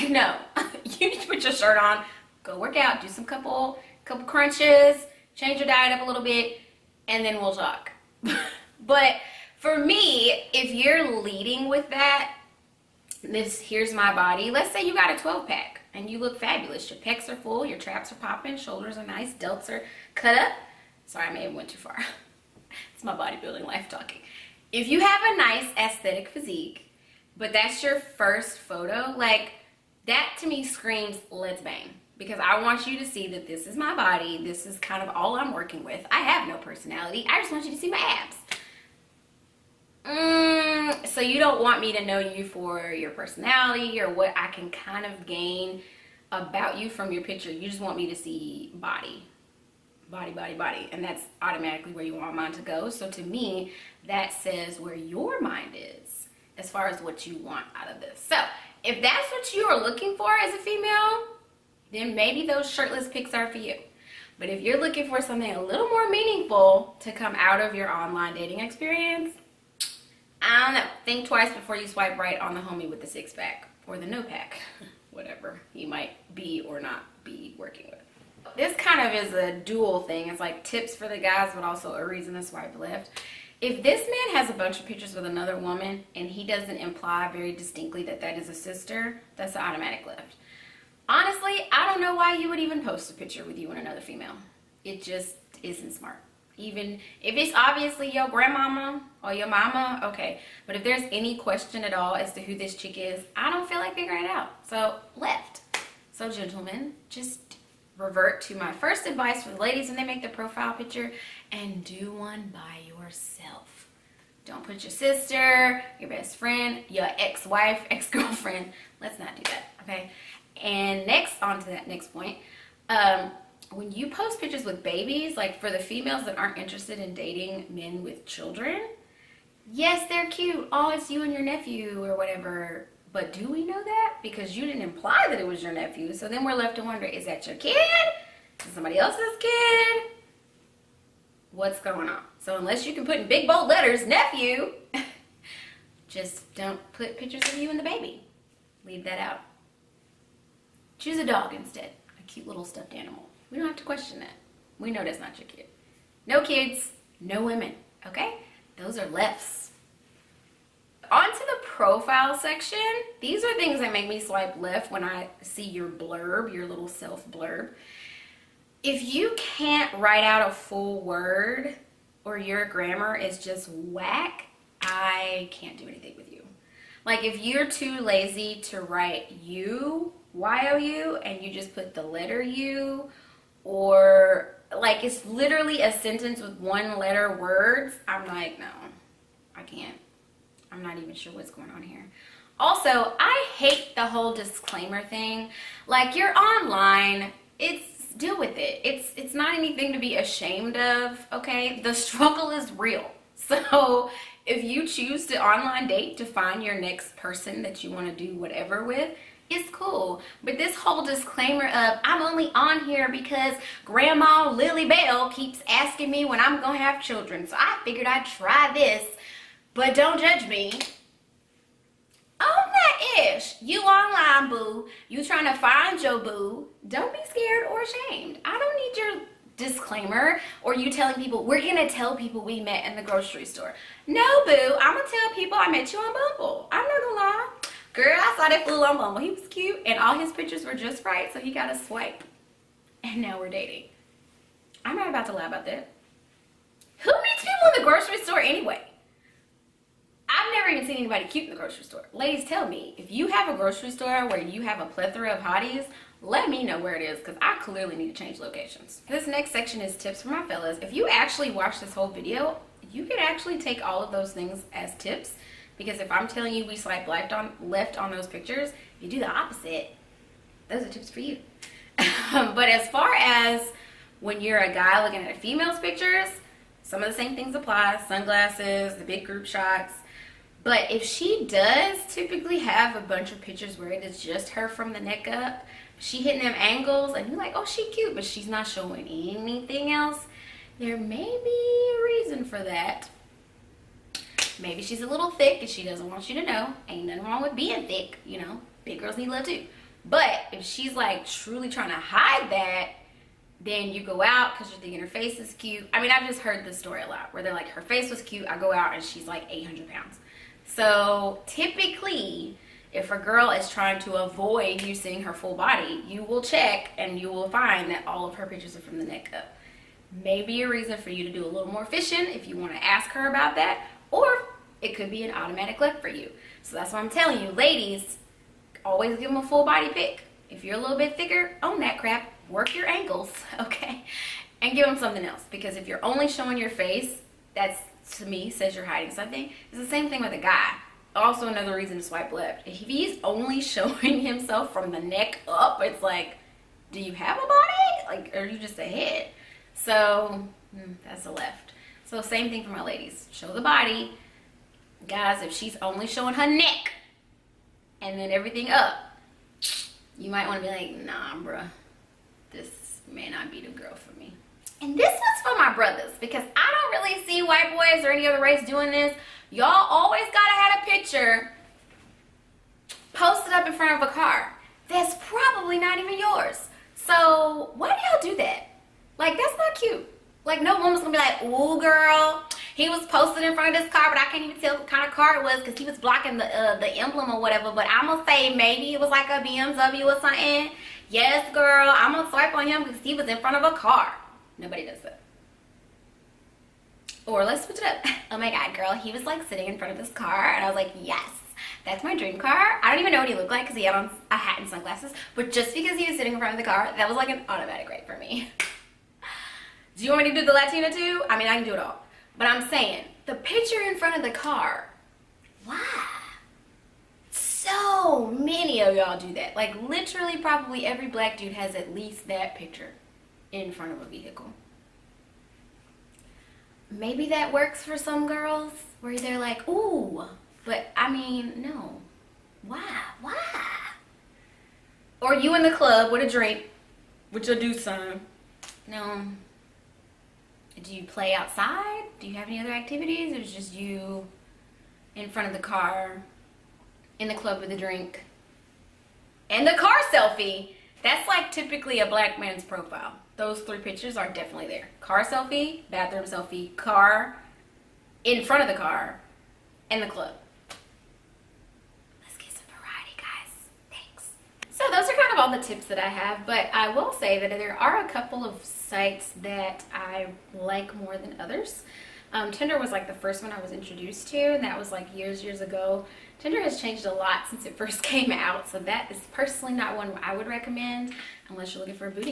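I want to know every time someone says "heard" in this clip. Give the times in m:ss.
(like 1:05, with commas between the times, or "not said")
5:06.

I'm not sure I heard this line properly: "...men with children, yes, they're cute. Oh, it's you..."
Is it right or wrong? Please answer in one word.
right.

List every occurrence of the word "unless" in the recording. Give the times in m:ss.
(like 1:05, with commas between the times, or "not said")
2:22, 8:01.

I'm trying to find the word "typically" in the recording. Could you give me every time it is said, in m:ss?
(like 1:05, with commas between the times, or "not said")
4:42, 5:11, 7:31.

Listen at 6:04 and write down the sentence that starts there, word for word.
And this was for my brothers because I don't really see white boys or any other race doing this.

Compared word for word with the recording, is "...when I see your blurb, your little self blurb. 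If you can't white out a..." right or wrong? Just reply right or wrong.
wrong.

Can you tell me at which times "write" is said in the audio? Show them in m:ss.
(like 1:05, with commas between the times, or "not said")
2:49, 2:58.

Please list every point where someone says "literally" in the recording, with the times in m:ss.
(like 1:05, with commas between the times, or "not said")
3:05, 6:59.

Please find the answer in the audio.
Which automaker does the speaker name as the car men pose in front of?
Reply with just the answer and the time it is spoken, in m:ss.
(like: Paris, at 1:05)
BMW, at 6:29.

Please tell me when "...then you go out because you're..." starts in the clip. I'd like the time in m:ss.
5:03.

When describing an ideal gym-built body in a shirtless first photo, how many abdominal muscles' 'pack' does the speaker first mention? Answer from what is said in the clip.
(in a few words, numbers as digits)
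12 pack.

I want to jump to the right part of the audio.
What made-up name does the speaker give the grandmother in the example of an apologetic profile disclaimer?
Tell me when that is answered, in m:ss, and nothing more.
3:33.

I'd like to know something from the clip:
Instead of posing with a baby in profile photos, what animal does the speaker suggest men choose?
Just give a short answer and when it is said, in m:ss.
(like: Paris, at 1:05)
A dog, at 2:31.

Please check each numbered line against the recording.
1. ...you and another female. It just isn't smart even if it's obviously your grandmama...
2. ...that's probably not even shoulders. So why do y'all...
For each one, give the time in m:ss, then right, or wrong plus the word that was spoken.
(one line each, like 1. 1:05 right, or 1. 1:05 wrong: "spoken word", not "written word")
1. 1:33 right
2. 6:14 wrong: "yours", not "shoulders".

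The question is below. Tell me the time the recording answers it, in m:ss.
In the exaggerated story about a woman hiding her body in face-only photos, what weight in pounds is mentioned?
5:09.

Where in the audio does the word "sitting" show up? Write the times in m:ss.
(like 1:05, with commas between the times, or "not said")
6:39, 6:46.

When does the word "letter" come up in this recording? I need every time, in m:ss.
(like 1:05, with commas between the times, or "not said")
2:23, 3:02, 3:06.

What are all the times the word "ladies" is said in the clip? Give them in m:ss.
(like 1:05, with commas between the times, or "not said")
1:49, 4:12, 5:27, 5:52.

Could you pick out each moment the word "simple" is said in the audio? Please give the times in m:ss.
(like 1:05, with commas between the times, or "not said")
not said.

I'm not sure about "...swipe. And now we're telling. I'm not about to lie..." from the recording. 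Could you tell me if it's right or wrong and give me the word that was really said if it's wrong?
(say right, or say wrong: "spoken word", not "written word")
wrong: "dating", not "telling".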